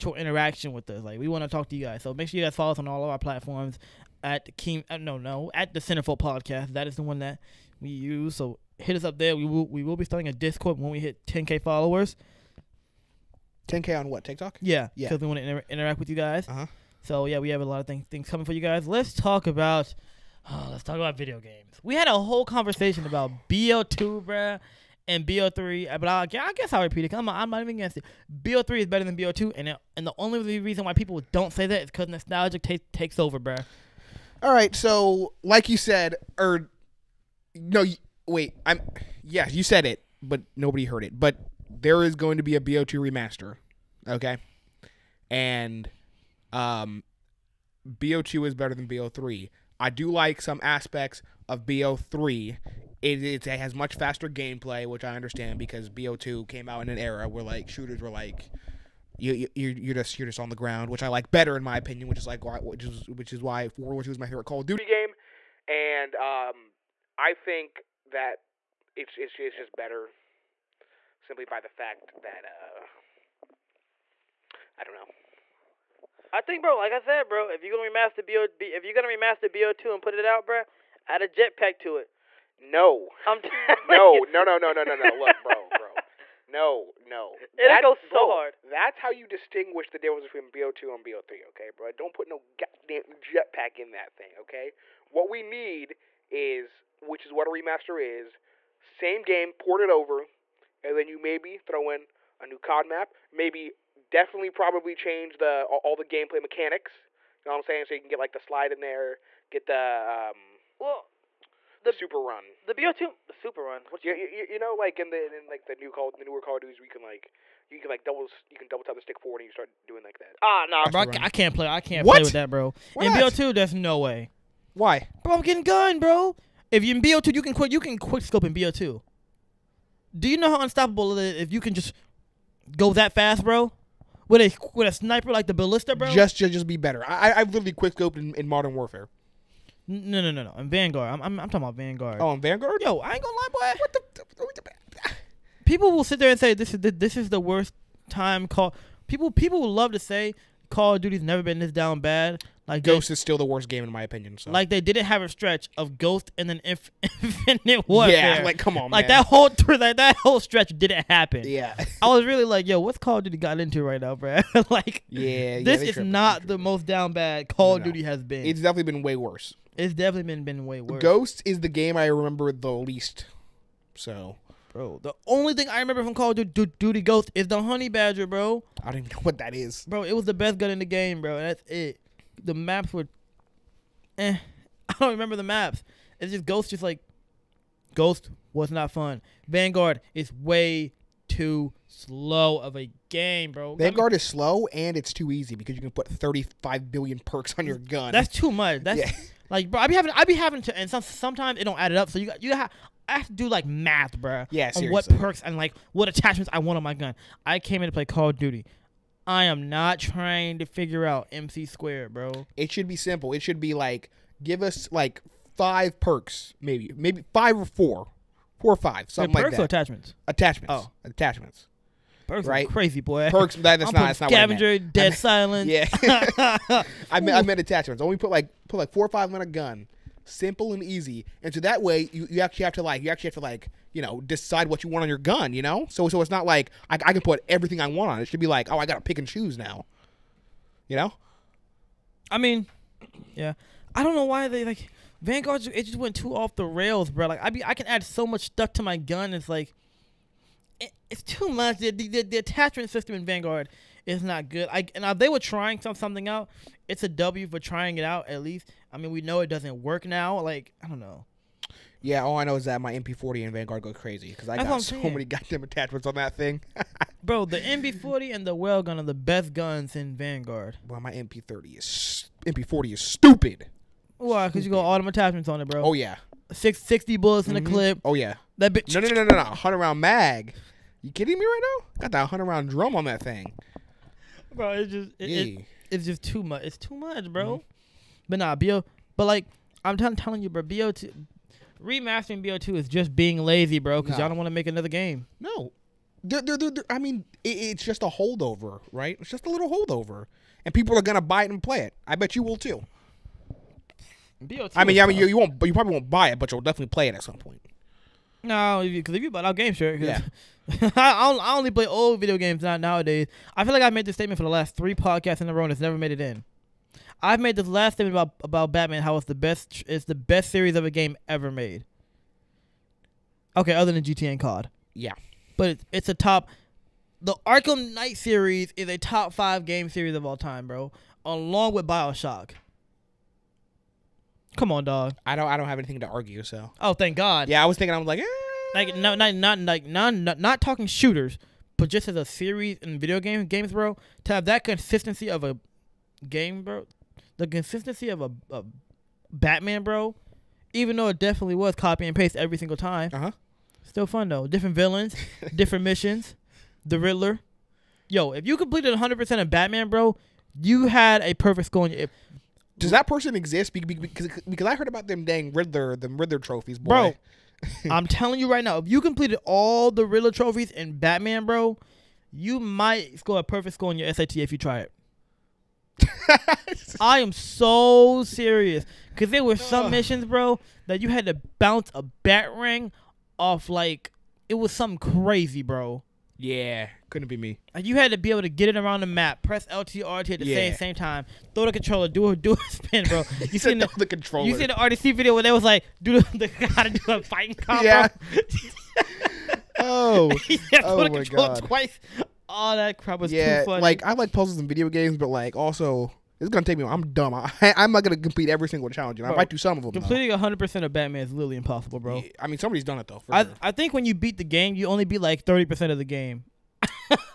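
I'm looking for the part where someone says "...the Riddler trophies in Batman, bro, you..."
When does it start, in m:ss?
6:09.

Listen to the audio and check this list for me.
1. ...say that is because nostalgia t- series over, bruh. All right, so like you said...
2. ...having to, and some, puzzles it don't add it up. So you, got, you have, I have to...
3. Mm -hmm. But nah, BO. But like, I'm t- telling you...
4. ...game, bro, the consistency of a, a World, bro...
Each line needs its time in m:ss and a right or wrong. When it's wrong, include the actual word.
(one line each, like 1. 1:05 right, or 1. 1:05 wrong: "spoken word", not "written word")
1. 0:31 wrong: "takes", not "series"
2. 3:20 wrong: "sometimes", not "puzzles"
3. 4:47 right
4. 5:46 wrong: "Batman", not "World".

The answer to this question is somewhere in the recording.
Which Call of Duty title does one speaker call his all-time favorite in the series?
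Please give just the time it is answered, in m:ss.
1:03.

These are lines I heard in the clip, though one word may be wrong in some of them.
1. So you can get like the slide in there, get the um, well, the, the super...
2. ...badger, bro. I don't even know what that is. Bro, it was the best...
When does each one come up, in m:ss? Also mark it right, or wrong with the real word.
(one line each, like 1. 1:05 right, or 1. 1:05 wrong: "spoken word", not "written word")
1. 1:47 right
2. 2:57 right.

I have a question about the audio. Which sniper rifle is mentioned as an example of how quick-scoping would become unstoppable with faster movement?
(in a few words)
Ballista.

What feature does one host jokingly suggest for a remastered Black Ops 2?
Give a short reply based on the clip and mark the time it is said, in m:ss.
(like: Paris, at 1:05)
A jetpack, at 1:21.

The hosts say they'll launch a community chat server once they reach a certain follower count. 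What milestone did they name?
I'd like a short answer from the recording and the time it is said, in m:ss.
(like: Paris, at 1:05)
10k, at 0:11.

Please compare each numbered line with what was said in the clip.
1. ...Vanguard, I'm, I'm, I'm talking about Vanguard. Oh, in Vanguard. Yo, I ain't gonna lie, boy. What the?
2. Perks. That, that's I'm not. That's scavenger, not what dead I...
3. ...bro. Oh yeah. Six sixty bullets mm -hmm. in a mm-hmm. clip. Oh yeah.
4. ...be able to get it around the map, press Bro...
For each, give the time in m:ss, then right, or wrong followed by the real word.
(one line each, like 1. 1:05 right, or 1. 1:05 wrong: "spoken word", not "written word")
1. 2:20 right
2. 3:43 right
3. 4:35 right
4. 6:28 wrong: "LTR", not "Bro".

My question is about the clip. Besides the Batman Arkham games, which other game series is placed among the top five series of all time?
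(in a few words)
Bioshock.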